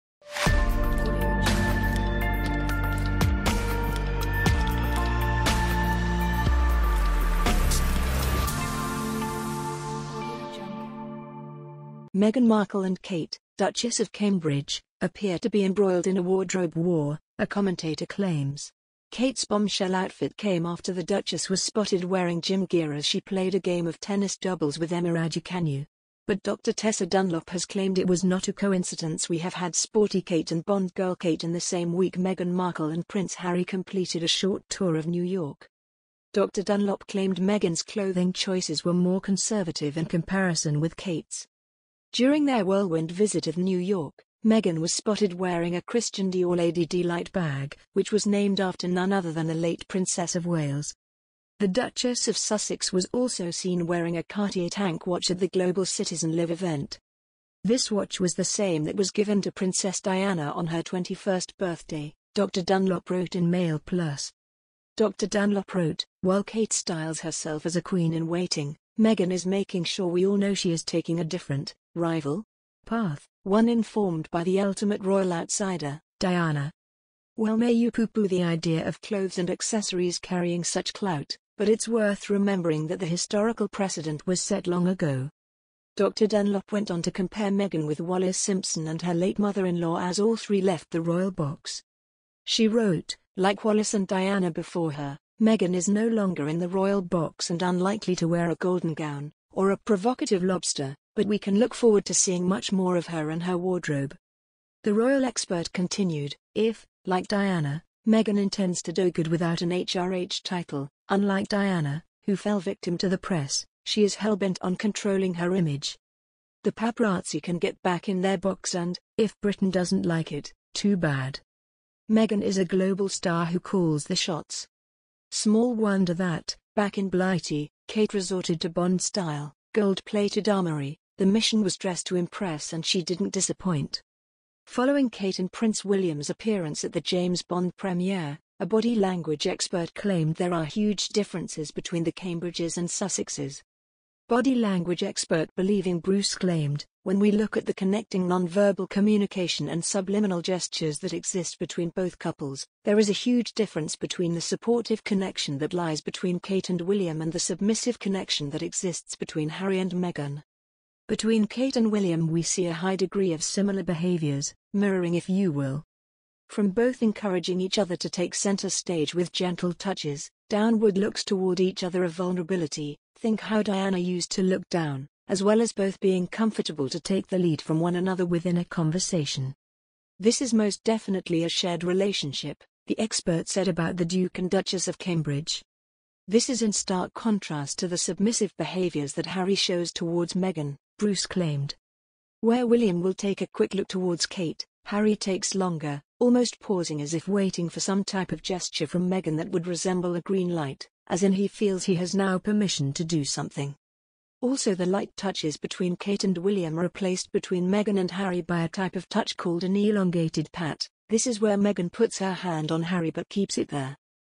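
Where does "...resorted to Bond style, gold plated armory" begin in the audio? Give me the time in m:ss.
2:08.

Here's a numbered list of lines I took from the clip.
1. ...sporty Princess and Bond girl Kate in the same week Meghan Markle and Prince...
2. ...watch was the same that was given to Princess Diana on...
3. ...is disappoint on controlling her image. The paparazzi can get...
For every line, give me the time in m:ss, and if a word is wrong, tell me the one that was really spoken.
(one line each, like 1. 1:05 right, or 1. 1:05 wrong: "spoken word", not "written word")
1. 0:29 wrong: "Kate", not "Princess"
2. 0:57 right
3. 1:54 wrong: "hellbent", not "disappoint".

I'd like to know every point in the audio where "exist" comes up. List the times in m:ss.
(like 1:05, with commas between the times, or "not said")
2:31, 2:38.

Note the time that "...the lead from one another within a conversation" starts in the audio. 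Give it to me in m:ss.
2:57.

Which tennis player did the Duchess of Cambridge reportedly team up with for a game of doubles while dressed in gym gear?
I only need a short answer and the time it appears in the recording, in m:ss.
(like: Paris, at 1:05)
Emma Raducanu, at 0:24.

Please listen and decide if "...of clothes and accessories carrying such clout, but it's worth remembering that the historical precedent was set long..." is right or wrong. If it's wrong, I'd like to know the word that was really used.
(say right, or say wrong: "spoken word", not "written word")
right.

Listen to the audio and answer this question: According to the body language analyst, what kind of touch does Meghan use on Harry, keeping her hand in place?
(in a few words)
Elongated pat.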